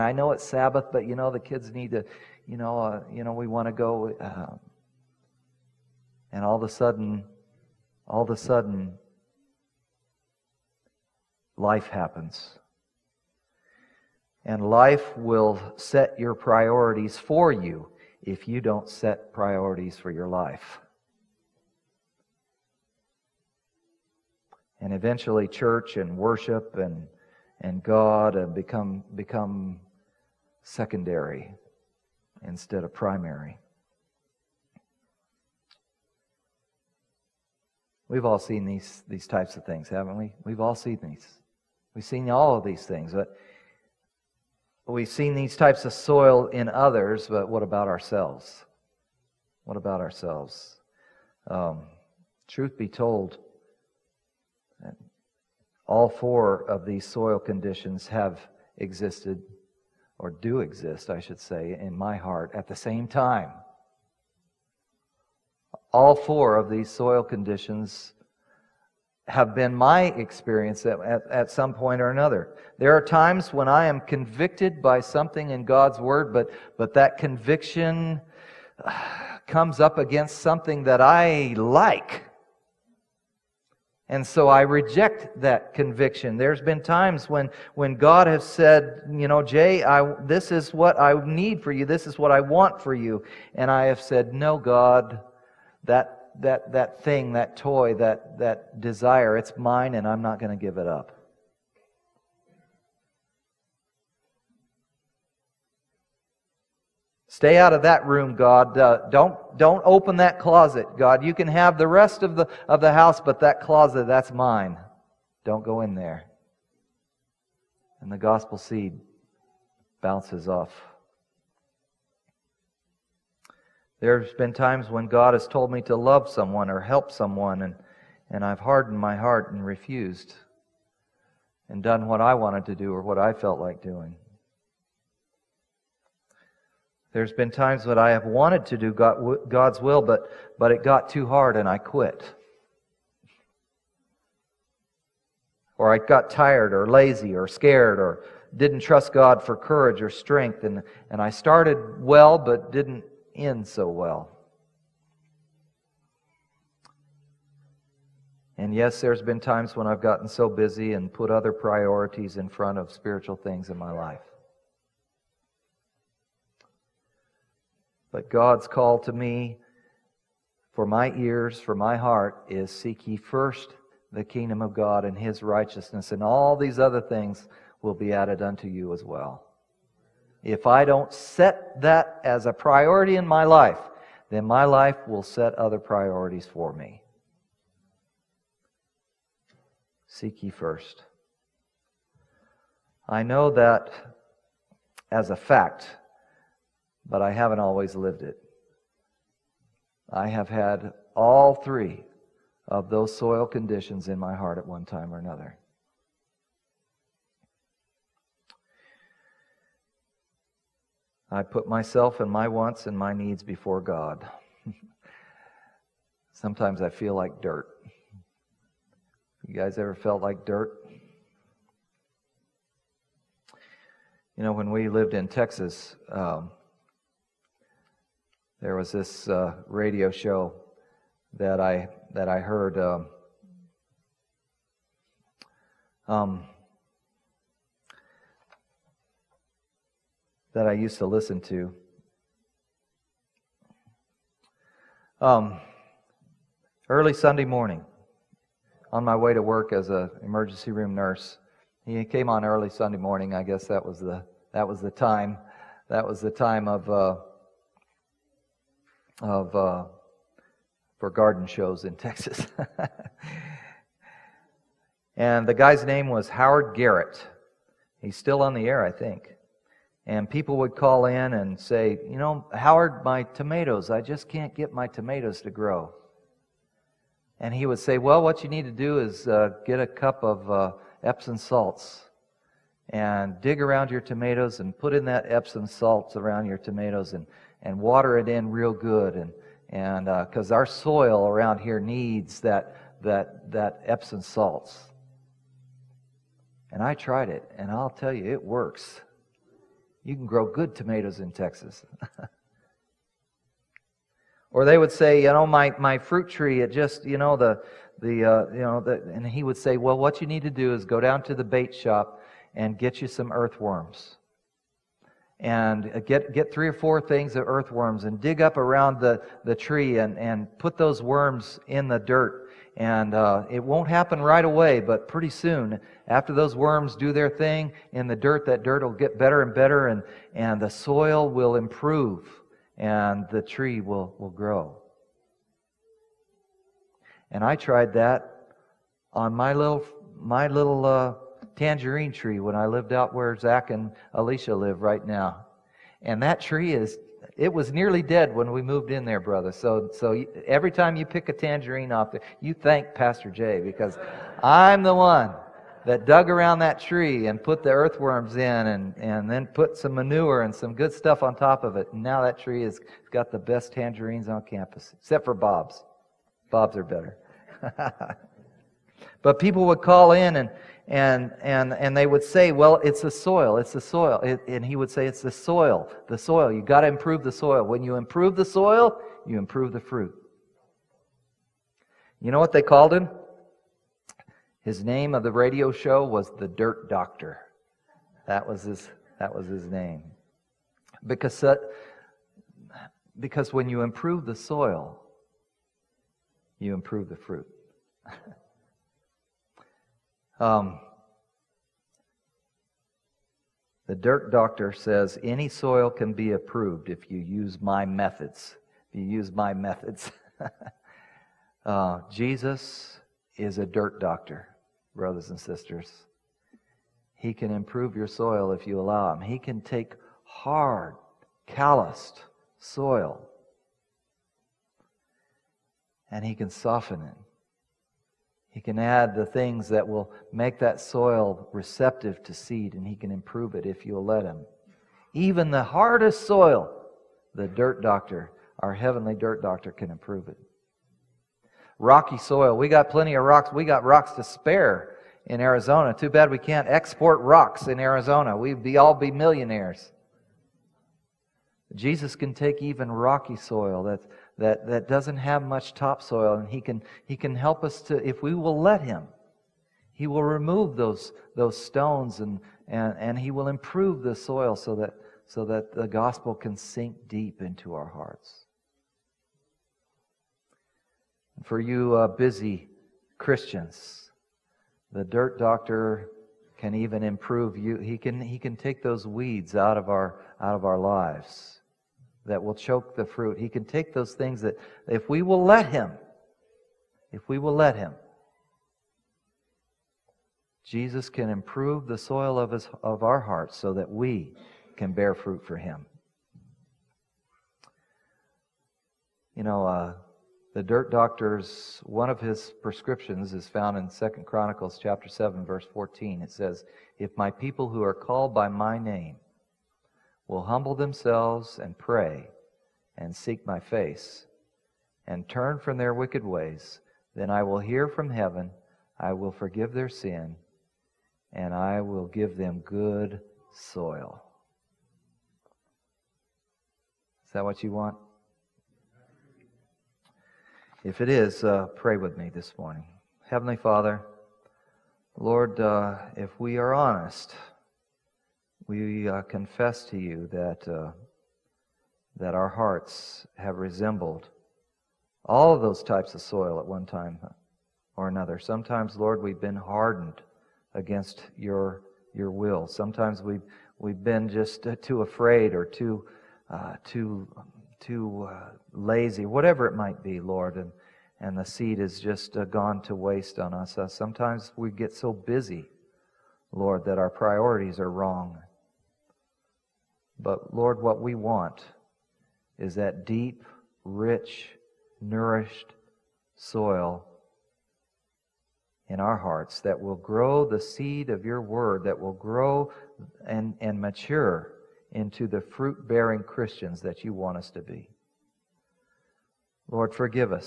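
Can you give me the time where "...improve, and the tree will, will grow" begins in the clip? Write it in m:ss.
5:31.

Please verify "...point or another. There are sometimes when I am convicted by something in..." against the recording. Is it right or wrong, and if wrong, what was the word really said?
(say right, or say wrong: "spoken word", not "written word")
wrong: "times", not "sometimes".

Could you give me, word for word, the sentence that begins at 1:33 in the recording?
And I have said, no, God, that that, that, thing, that toy, that, that desire.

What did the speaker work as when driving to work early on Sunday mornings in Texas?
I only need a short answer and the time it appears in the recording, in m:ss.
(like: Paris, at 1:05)
Emergency room nurse, at 4:10.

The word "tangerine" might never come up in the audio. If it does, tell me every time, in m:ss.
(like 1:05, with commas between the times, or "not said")
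5:41, 5:51, 6:03.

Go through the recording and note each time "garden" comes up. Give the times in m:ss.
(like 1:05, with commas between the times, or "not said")
4:21.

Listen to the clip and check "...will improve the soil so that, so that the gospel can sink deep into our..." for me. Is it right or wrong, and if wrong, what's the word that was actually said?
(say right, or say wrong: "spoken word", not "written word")
right.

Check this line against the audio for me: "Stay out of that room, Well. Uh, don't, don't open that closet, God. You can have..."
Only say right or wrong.
wrong.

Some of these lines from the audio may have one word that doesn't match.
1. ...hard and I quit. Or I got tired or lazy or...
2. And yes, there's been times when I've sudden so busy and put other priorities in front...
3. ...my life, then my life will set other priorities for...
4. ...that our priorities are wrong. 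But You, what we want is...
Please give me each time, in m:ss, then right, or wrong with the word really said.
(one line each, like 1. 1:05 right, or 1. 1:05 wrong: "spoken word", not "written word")
1. 2:21 right
2. 2:38 wrong: "gotten", not "sudden"
3. 3:03 right
4. 9:26 wrong: "Lord", not "You".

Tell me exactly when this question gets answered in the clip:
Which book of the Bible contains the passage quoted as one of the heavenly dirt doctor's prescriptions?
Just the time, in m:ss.
8:23.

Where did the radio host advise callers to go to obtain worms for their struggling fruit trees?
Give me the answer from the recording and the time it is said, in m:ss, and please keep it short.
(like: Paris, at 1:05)
The bait shop, at 5:11.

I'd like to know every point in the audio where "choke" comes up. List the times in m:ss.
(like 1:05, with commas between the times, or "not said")
8:02.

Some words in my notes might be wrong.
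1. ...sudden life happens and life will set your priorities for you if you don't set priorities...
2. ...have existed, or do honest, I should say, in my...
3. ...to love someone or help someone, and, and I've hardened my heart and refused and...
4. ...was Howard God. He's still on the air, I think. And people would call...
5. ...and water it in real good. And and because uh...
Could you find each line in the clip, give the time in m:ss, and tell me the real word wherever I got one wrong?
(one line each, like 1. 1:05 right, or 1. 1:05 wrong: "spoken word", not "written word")
1. 0:08 right
2. 0:58 wrong: "exist", not "honest"
3. 2:05 right
4. 4:26 wrong: "Garrett", not "God"
5. 4:47 right.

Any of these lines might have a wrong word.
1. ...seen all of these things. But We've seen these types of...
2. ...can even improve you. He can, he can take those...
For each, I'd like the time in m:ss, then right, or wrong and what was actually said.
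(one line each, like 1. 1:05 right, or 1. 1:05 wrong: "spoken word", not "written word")
1. 0:42 right
2. 7:56 right.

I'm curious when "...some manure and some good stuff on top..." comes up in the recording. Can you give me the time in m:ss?
5:59.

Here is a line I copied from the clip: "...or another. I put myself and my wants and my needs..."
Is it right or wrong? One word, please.
right.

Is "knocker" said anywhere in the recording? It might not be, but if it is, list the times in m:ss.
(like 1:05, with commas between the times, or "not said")
not said.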